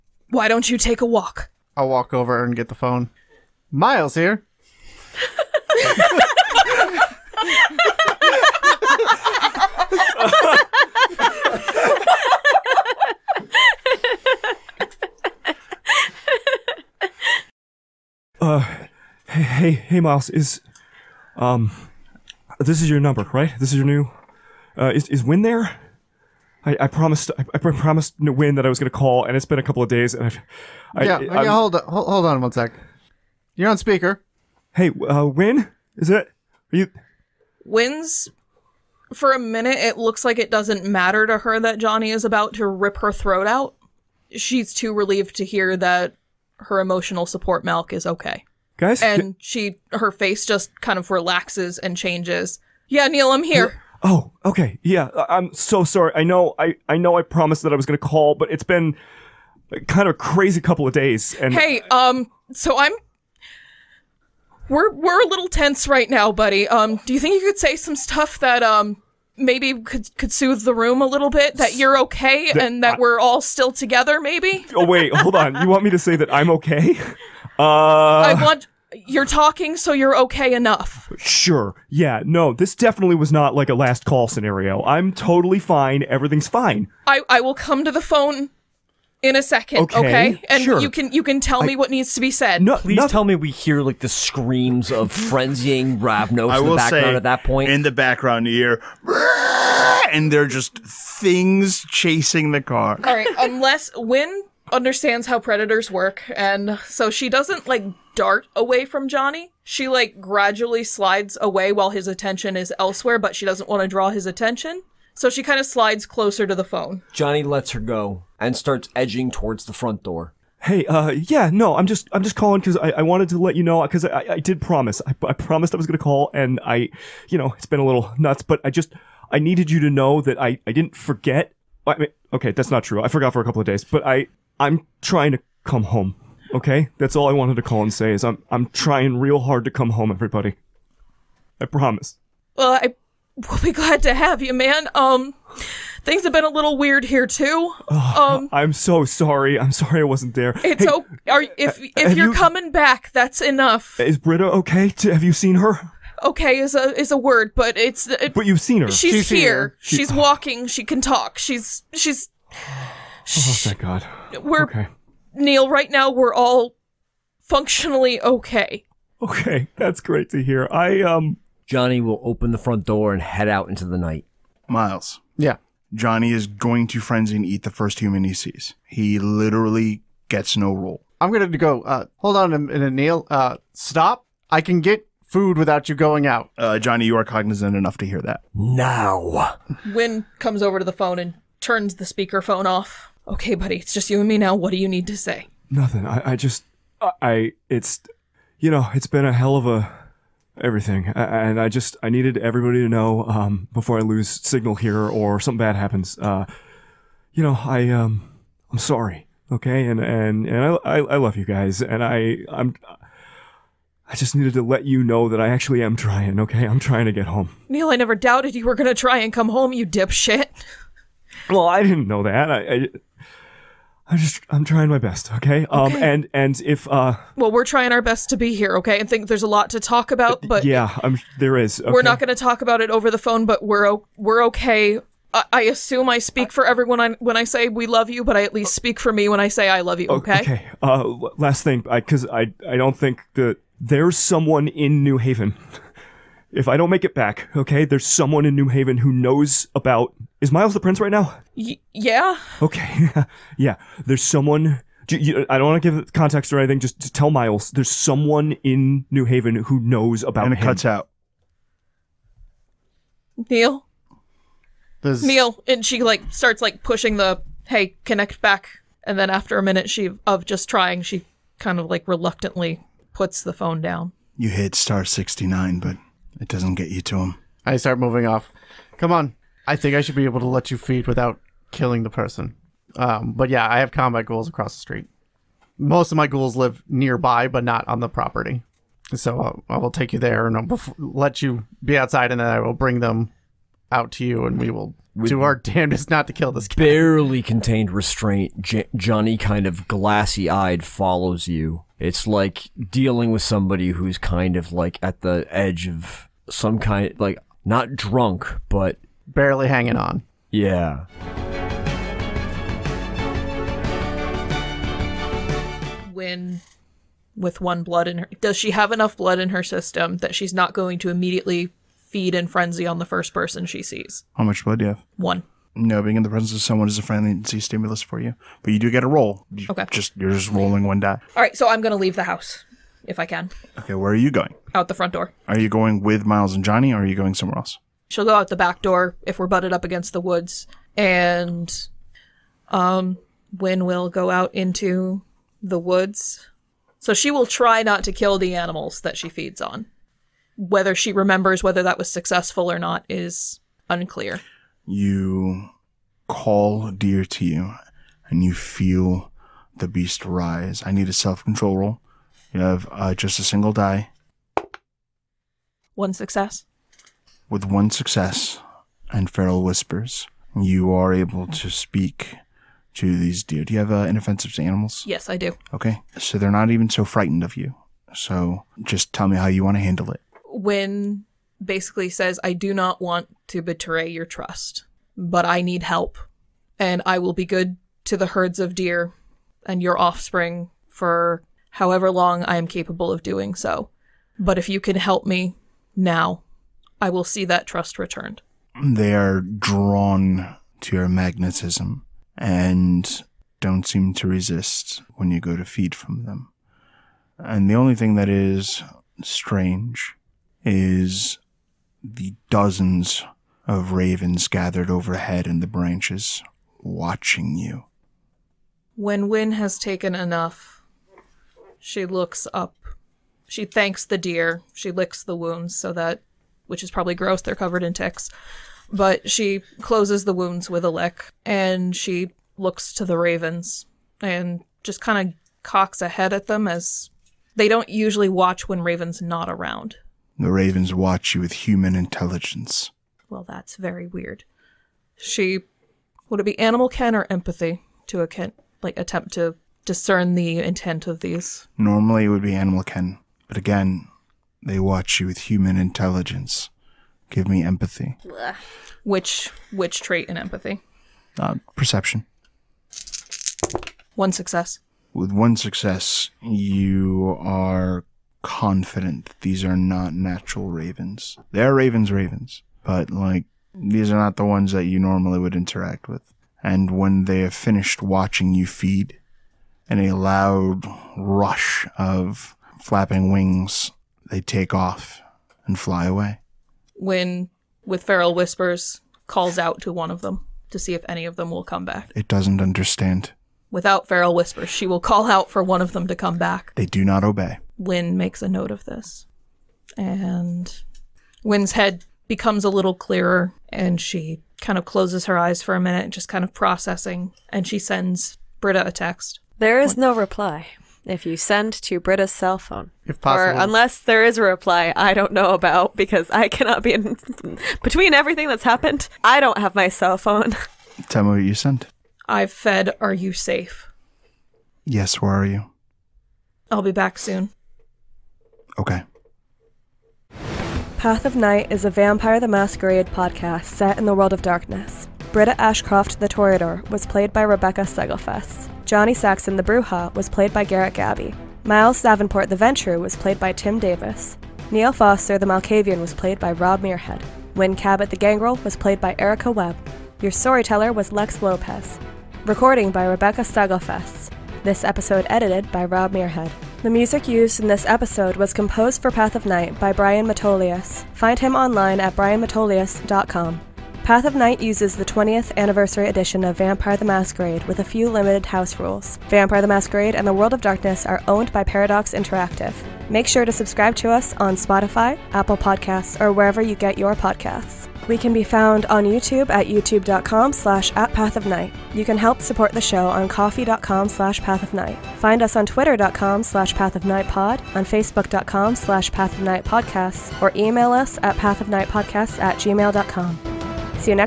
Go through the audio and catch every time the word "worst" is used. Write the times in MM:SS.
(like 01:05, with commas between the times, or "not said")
not said.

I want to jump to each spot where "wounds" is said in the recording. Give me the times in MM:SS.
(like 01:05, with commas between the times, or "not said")
07:05, 07:10.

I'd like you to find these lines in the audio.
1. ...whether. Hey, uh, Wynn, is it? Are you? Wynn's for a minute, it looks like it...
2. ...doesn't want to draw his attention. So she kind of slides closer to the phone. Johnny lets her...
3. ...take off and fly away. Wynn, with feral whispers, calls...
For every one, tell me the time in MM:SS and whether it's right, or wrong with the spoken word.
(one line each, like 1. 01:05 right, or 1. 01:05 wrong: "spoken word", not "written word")
1. 00:33 wrong: "speaker", not "whether"
2. 01:53 right
3. 08:04 right.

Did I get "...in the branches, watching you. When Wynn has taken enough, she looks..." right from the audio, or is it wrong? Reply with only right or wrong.
right.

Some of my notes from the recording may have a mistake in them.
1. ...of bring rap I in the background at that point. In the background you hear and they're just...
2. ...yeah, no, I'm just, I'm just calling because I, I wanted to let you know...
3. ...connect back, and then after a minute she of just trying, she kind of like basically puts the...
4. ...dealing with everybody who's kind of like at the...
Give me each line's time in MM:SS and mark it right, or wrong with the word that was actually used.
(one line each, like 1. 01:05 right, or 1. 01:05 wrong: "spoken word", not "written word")
1. 01:34 wrong: "frenzying", not "bring"
2. 02:01 right
3. 04:28 wrong: "reluctantly", not "basically"
4. 05:02 wrong: "somebody", not "everybody".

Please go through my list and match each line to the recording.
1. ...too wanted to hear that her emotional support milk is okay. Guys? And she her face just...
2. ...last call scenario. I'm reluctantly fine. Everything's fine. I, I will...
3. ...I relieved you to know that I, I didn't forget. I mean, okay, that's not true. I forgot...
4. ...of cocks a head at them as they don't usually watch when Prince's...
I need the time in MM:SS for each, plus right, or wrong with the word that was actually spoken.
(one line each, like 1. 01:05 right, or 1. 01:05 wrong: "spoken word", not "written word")
1. 00:44 wrong: "relieved", not "wanted"
2. 01:23 wrong: "totally", not "reluctantly"
3. 02:09 wrong: "needed", not "relieved"
4. 07:15 wrong: "Raven", not "Prince".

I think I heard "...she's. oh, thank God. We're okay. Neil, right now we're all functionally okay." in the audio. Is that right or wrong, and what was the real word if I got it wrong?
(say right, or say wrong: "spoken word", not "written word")
right.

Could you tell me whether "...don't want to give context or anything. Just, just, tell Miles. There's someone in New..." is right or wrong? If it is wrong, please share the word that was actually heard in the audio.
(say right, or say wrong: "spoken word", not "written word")
right.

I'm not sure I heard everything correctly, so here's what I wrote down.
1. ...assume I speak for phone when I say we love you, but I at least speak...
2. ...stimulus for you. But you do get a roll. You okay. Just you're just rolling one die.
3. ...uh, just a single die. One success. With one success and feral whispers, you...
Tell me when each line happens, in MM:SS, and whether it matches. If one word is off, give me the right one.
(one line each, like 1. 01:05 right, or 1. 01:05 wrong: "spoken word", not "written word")
1. 03:55 wrong: "everyone", not "phone"
2. 05:27 right
3. 06:02 right.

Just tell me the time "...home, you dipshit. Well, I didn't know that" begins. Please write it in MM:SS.
03:39.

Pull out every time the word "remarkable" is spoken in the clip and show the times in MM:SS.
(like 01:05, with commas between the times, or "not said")
not said.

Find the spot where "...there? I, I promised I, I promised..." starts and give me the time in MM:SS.
00:25.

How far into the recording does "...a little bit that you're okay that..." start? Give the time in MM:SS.
01:11.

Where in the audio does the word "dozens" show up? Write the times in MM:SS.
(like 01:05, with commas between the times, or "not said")
06:52.